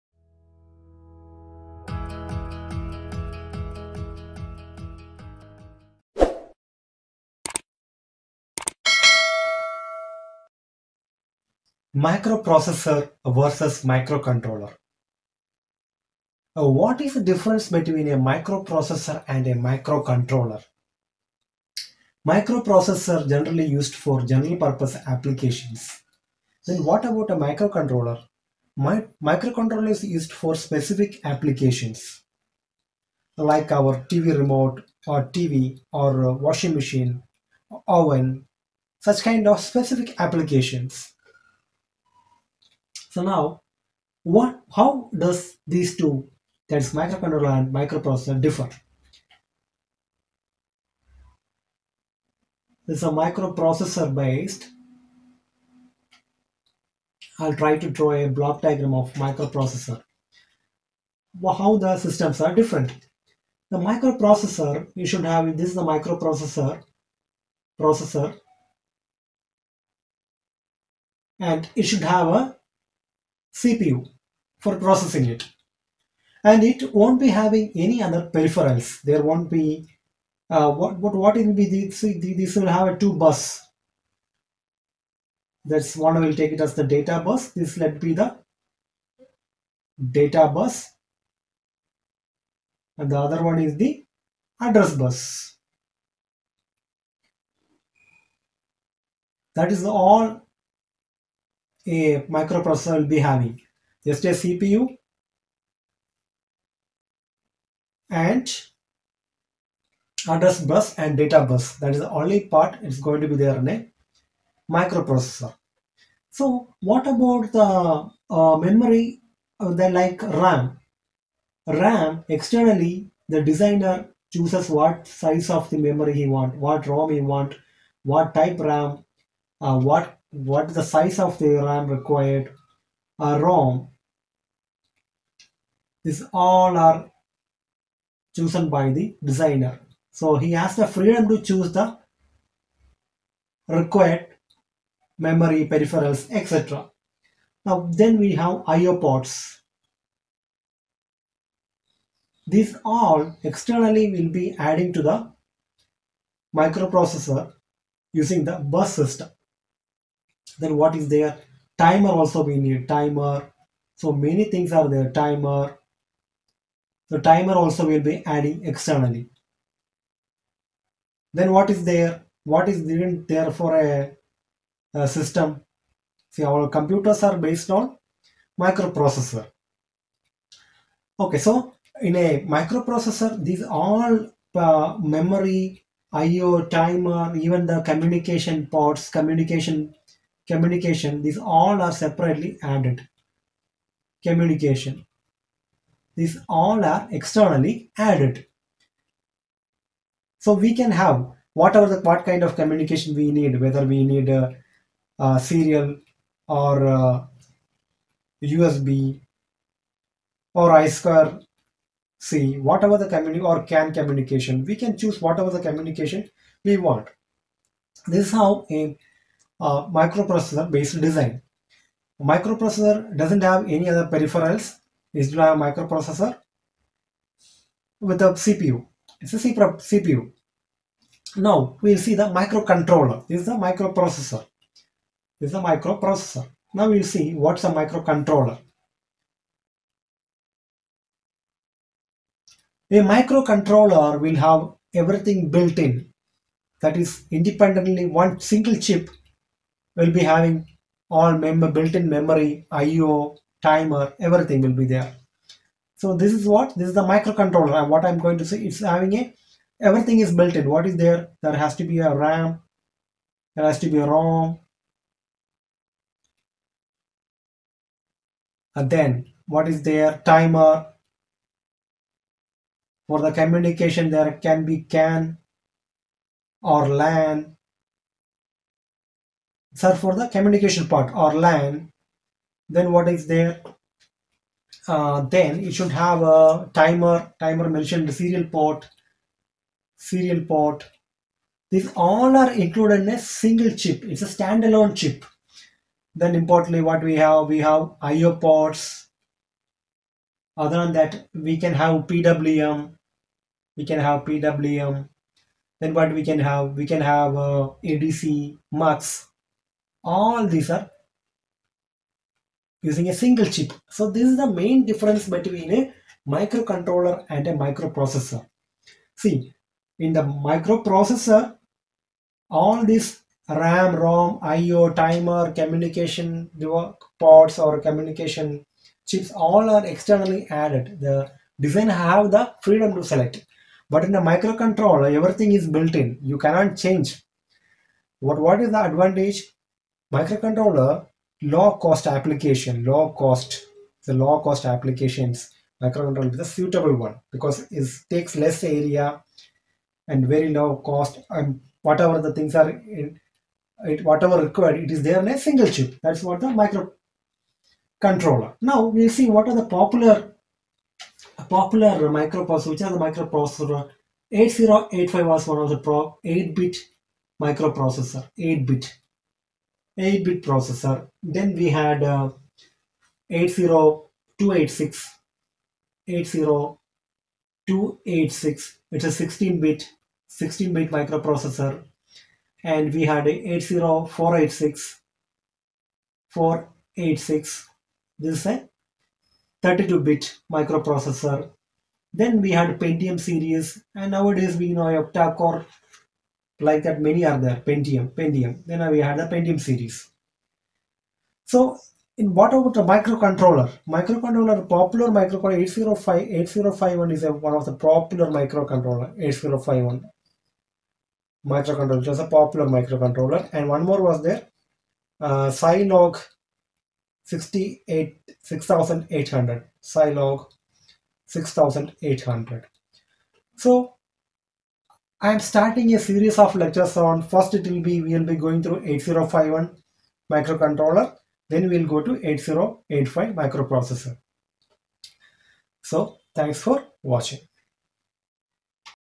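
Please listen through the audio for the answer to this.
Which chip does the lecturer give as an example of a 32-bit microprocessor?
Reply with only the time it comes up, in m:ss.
6:23.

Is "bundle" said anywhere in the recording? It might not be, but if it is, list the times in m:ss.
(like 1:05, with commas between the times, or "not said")
not said.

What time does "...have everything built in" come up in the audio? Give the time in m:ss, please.
4:04.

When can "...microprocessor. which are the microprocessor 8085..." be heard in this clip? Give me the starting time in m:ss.
6:02.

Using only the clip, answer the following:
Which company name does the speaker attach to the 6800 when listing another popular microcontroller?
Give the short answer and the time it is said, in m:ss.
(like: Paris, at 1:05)
Zilog, at 6:59.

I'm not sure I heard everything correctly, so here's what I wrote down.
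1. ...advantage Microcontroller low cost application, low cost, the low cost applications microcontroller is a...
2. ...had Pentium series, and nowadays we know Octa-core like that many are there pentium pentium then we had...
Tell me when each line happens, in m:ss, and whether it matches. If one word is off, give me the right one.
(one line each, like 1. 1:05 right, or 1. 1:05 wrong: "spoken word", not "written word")
1. 5:38 right
2. 6:32 right.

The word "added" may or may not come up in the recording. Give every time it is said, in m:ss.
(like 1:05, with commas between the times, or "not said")
3:12, 3:17, 5:30.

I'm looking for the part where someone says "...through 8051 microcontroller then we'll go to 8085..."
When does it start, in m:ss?
7:08.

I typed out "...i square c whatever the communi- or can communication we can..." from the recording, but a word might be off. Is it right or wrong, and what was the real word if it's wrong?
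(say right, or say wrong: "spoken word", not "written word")
right.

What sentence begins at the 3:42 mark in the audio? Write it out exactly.
Microprocessor doesn't have any other peripherals.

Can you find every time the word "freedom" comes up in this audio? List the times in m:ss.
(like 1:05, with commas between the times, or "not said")
2:20, 5:32.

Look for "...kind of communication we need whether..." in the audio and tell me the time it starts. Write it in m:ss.
3:22.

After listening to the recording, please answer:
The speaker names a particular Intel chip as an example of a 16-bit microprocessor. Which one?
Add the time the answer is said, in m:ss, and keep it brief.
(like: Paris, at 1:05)
80286, at 6:13.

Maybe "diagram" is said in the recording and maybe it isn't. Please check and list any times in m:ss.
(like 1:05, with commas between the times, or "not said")
0:58.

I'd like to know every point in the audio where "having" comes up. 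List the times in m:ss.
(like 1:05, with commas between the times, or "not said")
1:17, 1:43, 4:10, 4:18.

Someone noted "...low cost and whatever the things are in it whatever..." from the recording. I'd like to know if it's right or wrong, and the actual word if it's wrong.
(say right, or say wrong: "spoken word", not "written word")
right.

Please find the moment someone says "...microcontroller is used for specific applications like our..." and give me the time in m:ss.
0:29.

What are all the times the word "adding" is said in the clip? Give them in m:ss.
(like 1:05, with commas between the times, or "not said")
2:34, 2:48.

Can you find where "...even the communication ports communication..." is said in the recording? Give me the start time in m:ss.
3:07.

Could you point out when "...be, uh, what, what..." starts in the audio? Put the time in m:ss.
1:19.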